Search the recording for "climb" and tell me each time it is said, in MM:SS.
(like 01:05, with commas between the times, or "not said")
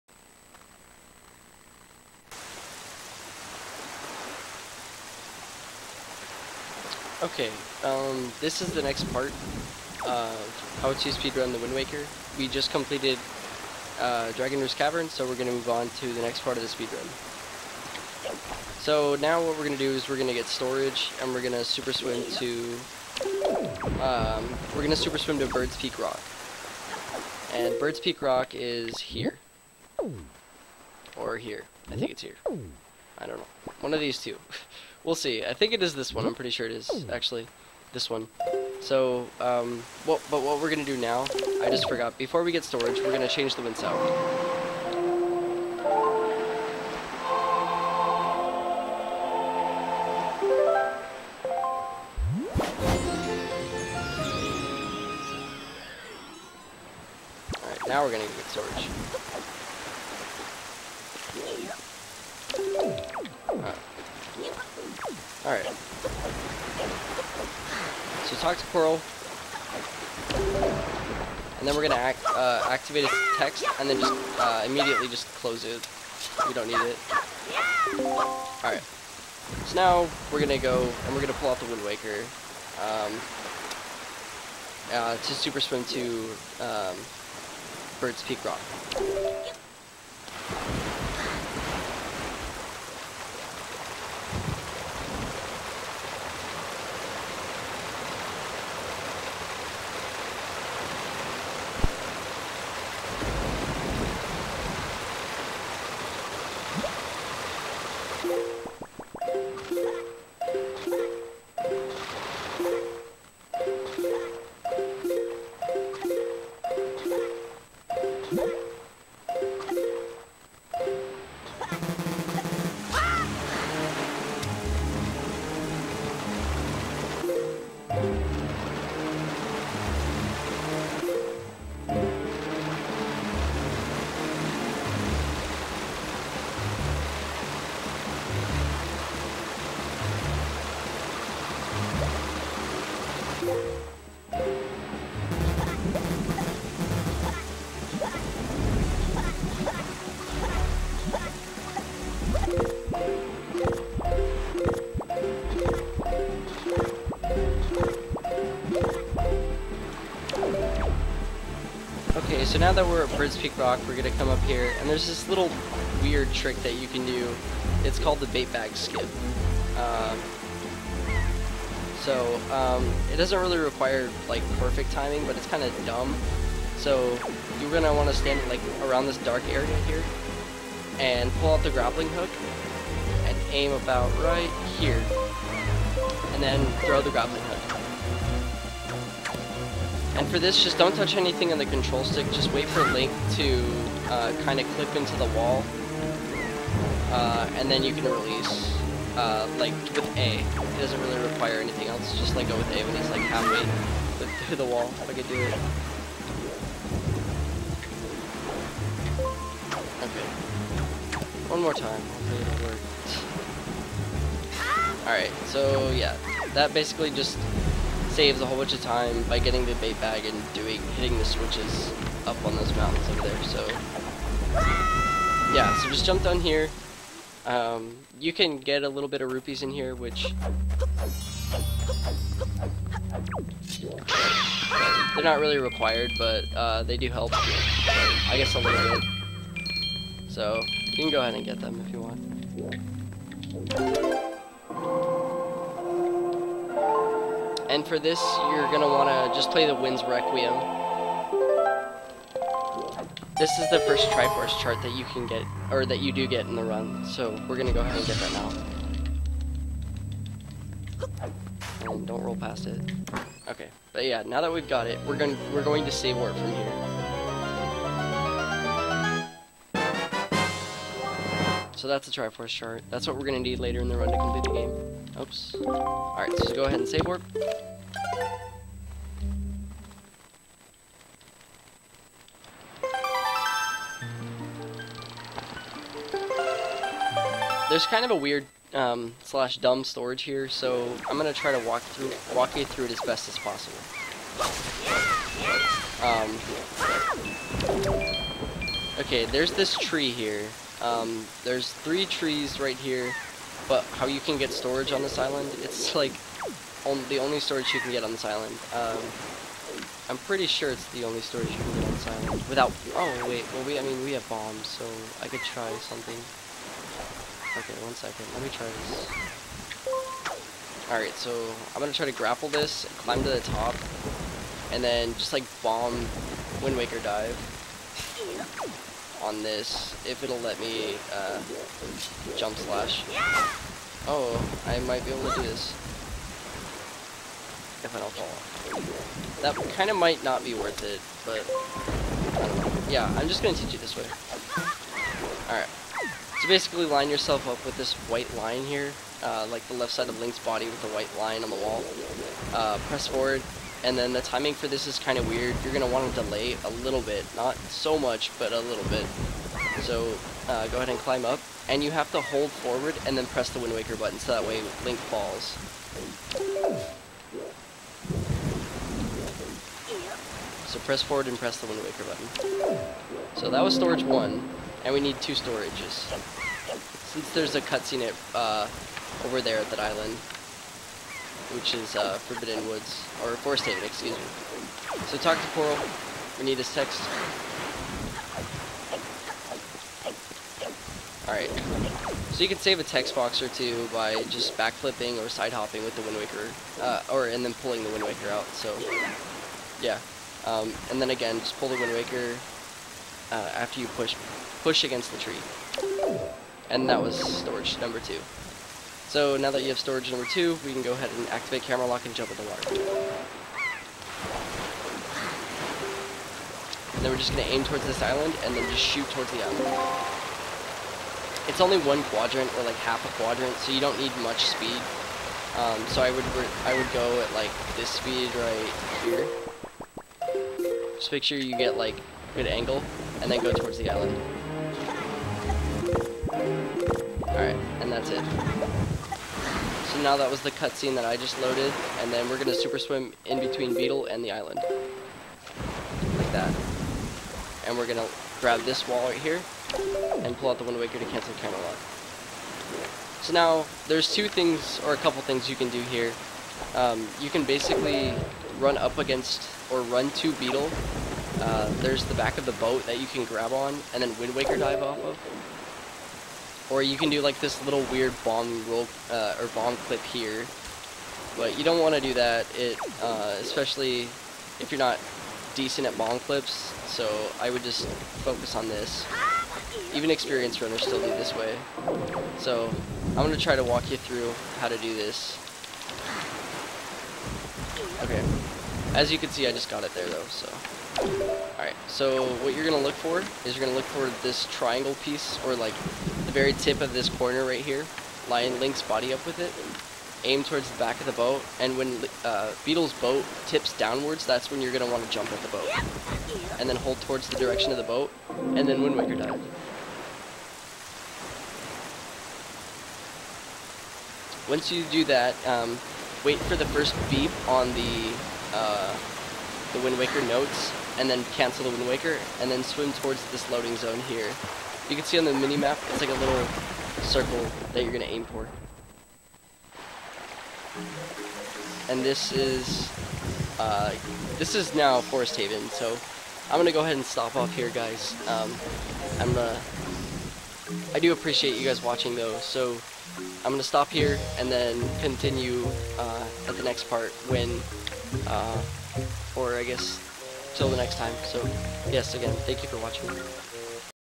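05:22, 06:00.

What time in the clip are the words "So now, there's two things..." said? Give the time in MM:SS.
07:33.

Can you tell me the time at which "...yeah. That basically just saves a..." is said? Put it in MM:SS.
03:35.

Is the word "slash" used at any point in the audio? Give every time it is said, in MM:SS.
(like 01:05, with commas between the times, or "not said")
04:49, 05:32.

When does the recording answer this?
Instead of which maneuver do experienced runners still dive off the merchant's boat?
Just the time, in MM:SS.
07:49.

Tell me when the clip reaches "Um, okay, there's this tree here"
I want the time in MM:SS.
04:57.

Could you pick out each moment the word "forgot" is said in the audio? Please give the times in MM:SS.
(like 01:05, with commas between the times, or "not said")
00:41.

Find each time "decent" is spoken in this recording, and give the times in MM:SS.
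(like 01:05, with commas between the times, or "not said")
07:55.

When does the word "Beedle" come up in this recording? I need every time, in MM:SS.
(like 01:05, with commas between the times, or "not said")
07:23, 07:40, 08:22.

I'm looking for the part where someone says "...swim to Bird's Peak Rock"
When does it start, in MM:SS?
00:25.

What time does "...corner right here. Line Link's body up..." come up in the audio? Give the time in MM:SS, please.
08:17.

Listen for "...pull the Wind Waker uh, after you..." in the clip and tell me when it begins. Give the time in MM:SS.
06:41.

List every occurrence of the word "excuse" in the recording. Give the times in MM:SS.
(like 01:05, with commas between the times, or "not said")
06:23.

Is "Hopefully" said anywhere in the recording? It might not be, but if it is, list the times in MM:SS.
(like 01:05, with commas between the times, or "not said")
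03:31.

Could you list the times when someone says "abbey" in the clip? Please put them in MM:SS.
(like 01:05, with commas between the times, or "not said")
not said.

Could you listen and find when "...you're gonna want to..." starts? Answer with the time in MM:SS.
02:57.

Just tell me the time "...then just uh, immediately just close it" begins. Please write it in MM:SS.
01:13.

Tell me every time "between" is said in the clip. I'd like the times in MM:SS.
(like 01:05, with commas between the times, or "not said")
07:23.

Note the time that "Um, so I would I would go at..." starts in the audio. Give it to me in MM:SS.
07:05.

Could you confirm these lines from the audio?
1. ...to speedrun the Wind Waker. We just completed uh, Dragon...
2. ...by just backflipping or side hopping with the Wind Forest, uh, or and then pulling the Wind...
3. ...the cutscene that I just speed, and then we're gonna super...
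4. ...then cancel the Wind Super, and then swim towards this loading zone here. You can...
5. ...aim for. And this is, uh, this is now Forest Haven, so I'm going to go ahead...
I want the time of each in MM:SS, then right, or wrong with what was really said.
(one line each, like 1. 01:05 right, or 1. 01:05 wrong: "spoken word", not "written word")
1. 00:10 right
2. 06:33 wrong: "Waker", not "Forest"
3. 07:20 wrong: "loaded", not "speed"
4. 08:41 wrong: "Waker", not "Super"
5. 08:48 right.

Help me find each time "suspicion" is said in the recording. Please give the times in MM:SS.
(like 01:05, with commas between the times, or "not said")
not said.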